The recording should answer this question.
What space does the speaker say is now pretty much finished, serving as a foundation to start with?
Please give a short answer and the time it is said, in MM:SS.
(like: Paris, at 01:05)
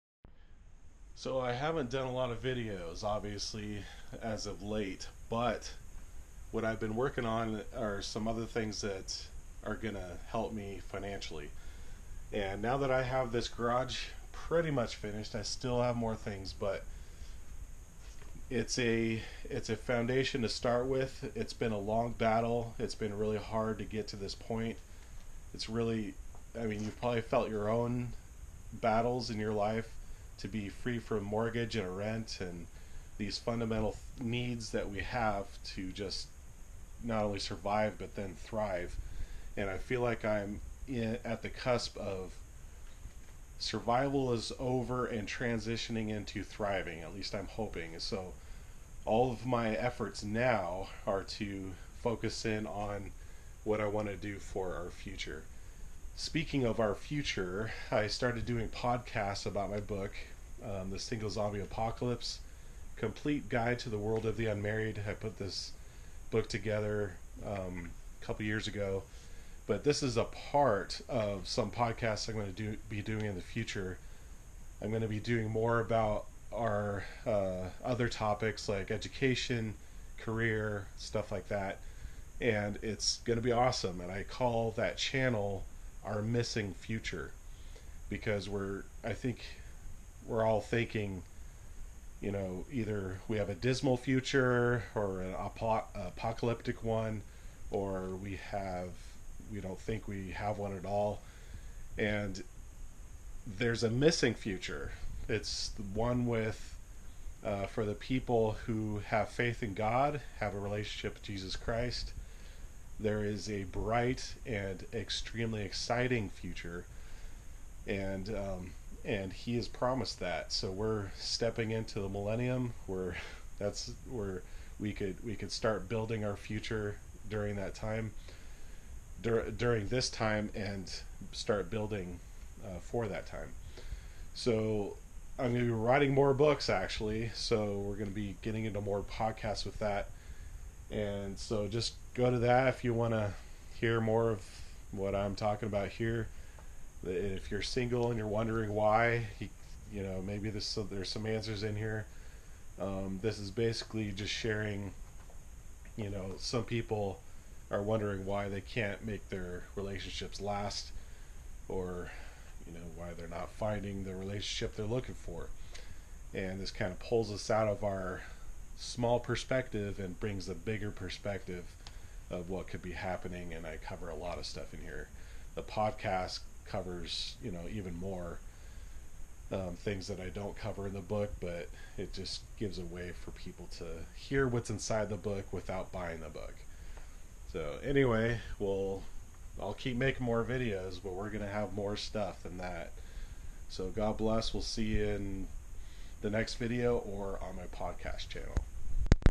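garage, at 00:13.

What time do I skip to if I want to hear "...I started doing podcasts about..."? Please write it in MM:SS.
00:57.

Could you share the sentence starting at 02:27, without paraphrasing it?
If you're single and you're wondering why, you, know, maybe this, there's some answers in here.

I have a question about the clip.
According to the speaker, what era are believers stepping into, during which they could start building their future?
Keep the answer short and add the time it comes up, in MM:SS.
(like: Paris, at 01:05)
the millennium, at 02:02.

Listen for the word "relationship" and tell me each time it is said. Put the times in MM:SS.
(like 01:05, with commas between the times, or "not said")
01:50, 02:39, 02:44.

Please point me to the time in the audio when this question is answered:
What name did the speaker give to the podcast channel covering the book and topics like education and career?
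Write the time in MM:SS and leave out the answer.
01:26.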